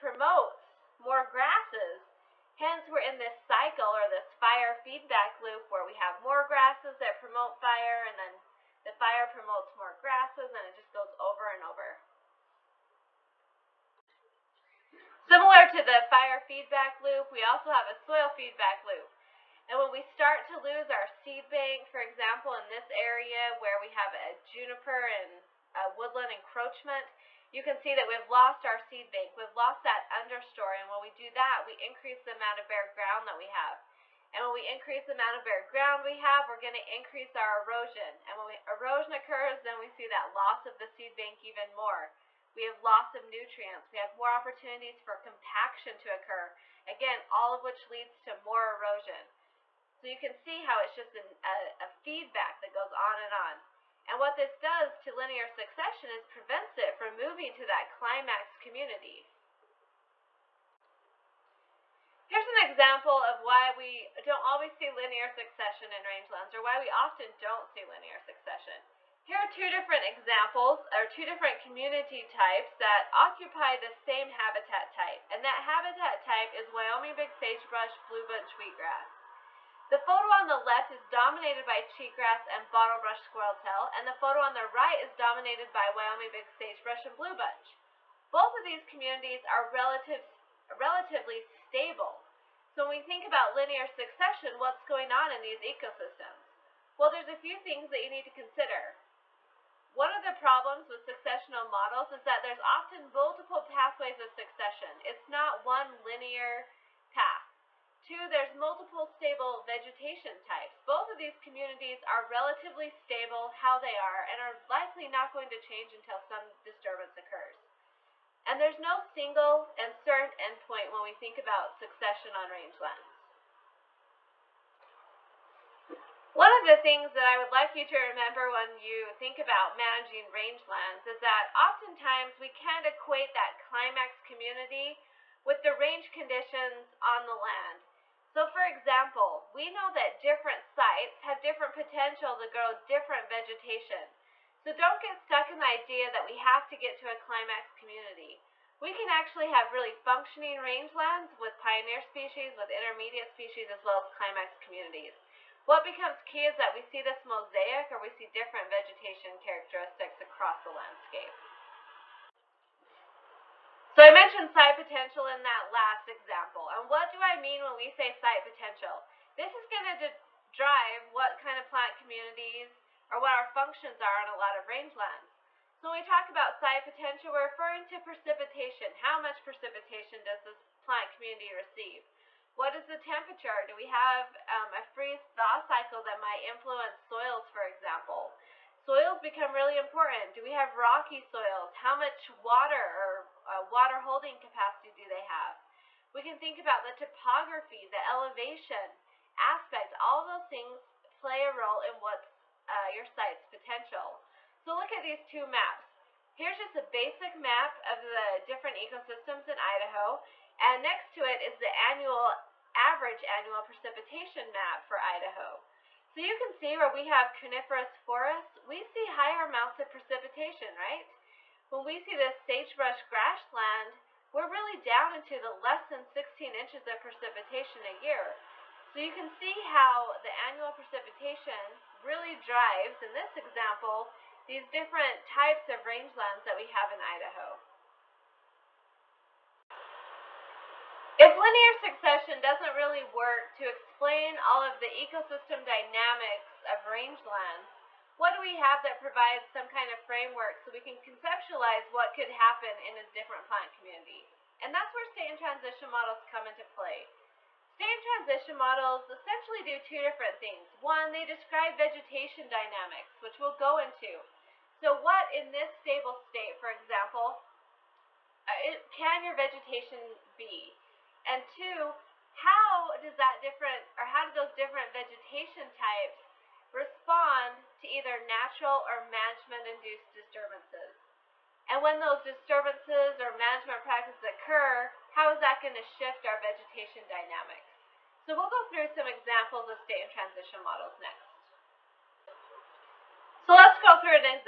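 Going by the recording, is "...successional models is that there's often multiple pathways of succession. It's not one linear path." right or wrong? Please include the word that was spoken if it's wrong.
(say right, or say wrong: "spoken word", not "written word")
right.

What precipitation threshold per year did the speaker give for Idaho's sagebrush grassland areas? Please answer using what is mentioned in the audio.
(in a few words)
less than 16 inches.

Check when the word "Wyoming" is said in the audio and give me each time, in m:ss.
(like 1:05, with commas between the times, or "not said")
1:16, 1:25.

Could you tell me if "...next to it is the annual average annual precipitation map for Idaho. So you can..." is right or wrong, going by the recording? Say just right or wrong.
right.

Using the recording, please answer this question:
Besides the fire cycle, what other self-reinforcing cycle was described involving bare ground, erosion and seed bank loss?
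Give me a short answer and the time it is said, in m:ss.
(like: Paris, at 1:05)
soil feedback loop, at 0:17.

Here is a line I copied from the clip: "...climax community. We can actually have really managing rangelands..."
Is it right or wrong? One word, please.
wrong.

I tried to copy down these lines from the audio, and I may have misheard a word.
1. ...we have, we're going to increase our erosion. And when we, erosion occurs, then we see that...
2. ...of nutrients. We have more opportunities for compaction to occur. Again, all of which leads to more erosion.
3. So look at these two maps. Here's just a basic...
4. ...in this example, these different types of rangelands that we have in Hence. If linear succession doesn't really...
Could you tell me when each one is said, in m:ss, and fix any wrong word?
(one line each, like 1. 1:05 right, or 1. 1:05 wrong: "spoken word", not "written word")
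1. 0:36 right
2. 0:43 right
3. 3:24 right
4. 3:53 wrong: "Idaho", not "Hence".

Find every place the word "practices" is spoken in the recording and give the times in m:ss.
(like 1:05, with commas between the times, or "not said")
4:43.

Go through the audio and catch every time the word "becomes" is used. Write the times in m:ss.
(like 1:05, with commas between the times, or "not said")
2:35, 3:09.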